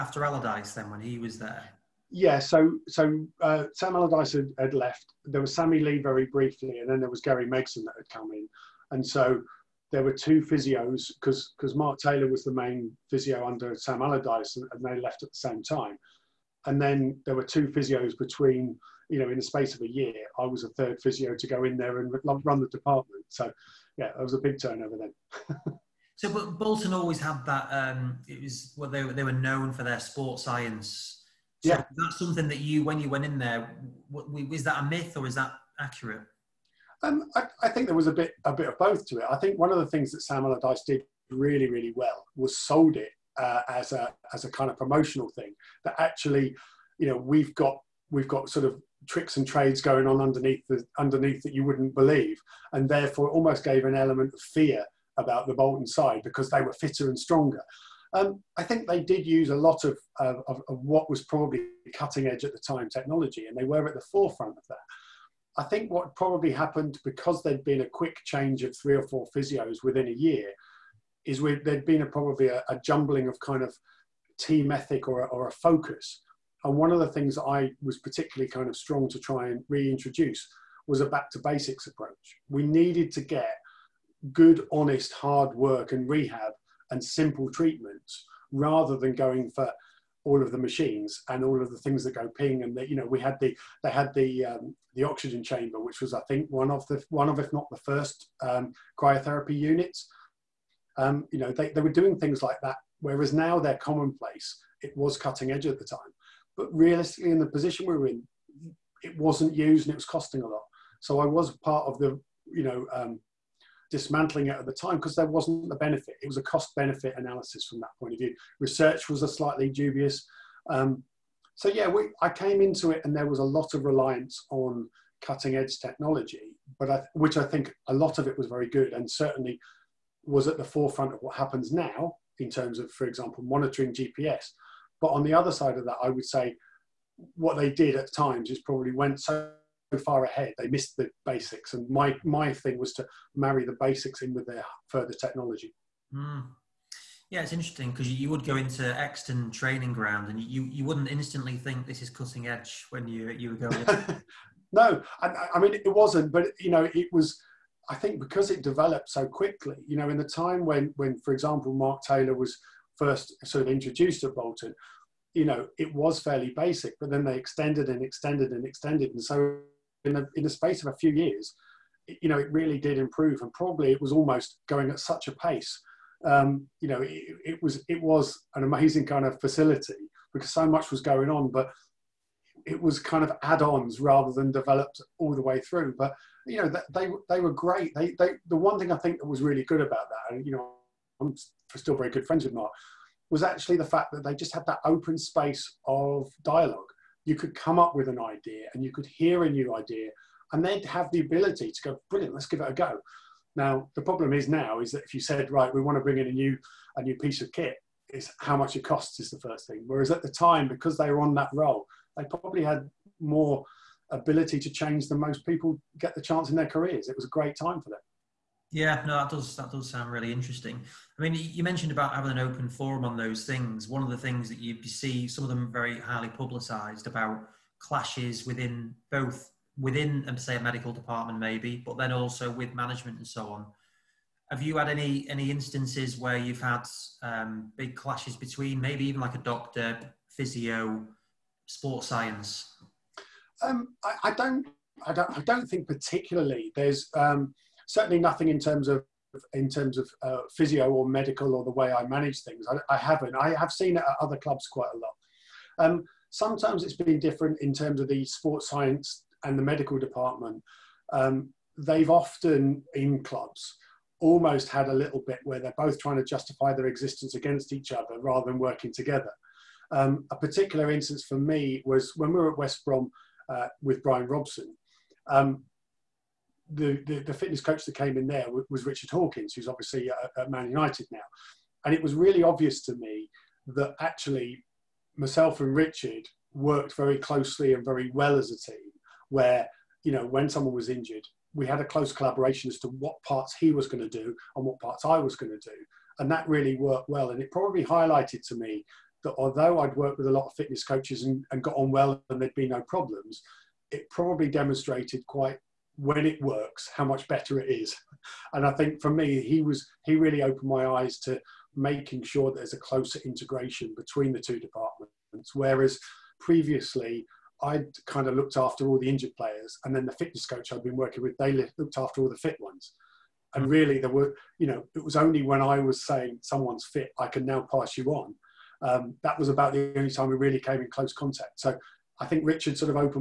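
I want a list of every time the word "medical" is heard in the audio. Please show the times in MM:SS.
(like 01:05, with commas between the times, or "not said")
03:50, 04:11, 04:19.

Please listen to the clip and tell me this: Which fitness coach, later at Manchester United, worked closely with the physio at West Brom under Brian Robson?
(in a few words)
Richard Hawkins.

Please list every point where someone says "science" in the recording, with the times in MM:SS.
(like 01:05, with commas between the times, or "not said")
00:30, 04:02, 04:18.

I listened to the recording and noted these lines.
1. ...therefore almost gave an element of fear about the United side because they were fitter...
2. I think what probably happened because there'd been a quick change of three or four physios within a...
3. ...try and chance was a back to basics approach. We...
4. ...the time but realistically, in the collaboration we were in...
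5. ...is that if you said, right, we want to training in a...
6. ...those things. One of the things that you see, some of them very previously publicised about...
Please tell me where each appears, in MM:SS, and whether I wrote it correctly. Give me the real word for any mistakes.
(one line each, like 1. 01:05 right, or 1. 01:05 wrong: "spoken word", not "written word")
1. 00:52 wrong: "Bolton", not "United"
2. 01:05 right
3. 01:19 wrong: "reintroduce", not "chance"
4. 01:45 wrong: "position", not "collaboration"
5. 03:24 wrong: "bring", not "training"
6. 03:43 wrong: "highly", not "previously".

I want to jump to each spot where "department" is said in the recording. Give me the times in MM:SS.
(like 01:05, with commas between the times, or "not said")
00:22, 03:50, 04:19, 05:14.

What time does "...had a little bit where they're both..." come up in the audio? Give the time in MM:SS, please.
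04:24.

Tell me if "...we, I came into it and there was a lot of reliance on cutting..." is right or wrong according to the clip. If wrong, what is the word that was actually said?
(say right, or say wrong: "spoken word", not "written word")
right.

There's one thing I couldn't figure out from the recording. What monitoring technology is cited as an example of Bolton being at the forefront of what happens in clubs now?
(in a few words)
GPS.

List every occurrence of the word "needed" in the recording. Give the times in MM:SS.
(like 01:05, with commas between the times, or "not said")
01:22.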